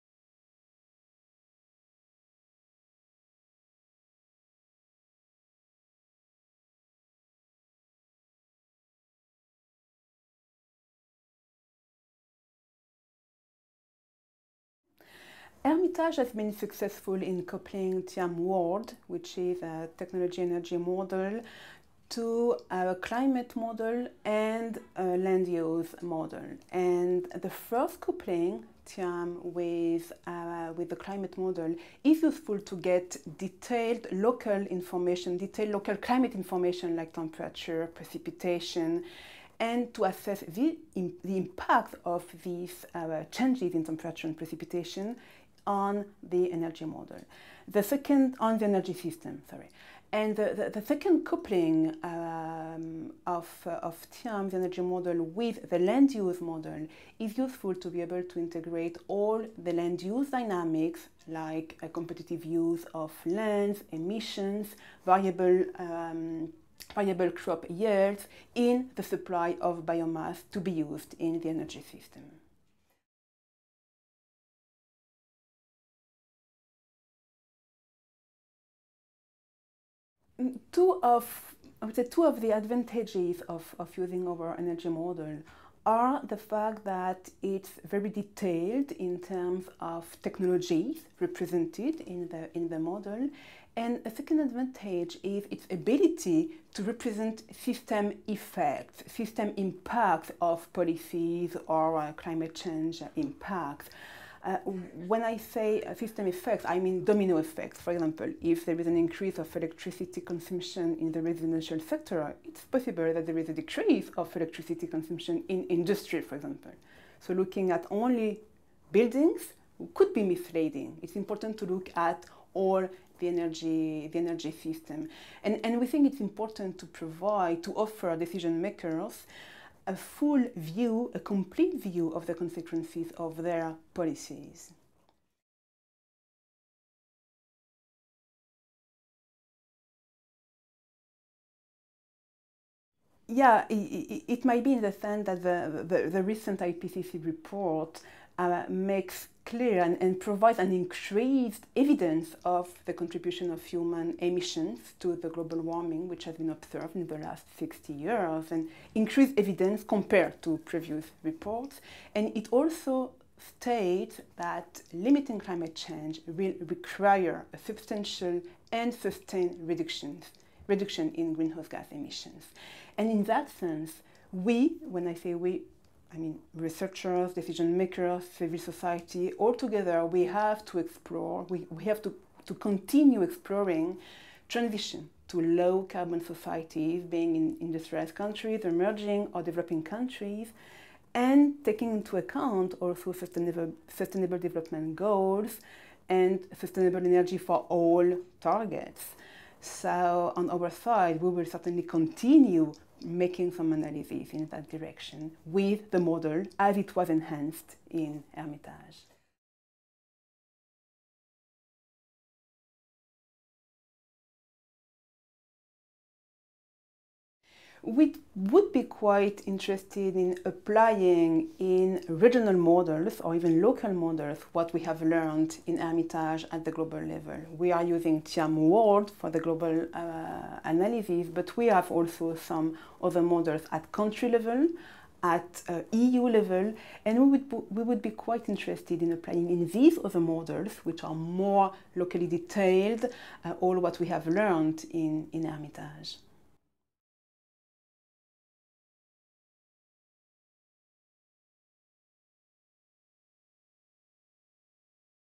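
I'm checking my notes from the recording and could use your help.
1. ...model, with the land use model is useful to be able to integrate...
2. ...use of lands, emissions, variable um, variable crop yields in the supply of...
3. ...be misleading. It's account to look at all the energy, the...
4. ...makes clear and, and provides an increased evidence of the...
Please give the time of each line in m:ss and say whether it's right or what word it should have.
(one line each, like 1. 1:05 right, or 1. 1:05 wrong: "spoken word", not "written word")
1. 0:54 right
2. 1:02 right
3. 2:00 wrong: "important", not "account"
4. 2:28 right.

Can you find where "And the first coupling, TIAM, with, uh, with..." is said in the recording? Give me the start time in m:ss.
0:26.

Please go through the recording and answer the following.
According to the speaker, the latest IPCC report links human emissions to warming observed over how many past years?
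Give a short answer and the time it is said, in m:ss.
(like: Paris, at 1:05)
60, at 2:37.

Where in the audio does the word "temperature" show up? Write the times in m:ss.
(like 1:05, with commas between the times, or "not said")
0:37, 0:43.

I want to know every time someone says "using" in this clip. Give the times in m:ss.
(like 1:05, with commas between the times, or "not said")
1:23, 3:47.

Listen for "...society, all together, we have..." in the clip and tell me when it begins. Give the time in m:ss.
2:58.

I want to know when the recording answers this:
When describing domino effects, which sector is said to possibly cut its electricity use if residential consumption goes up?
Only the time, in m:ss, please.
1:55.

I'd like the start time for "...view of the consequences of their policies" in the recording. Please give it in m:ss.
2:11.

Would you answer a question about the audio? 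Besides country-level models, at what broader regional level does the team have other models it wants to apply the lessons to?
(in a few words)
EU.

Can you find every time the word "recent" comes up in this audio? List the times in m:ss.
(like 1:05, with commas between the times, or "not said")
2:26.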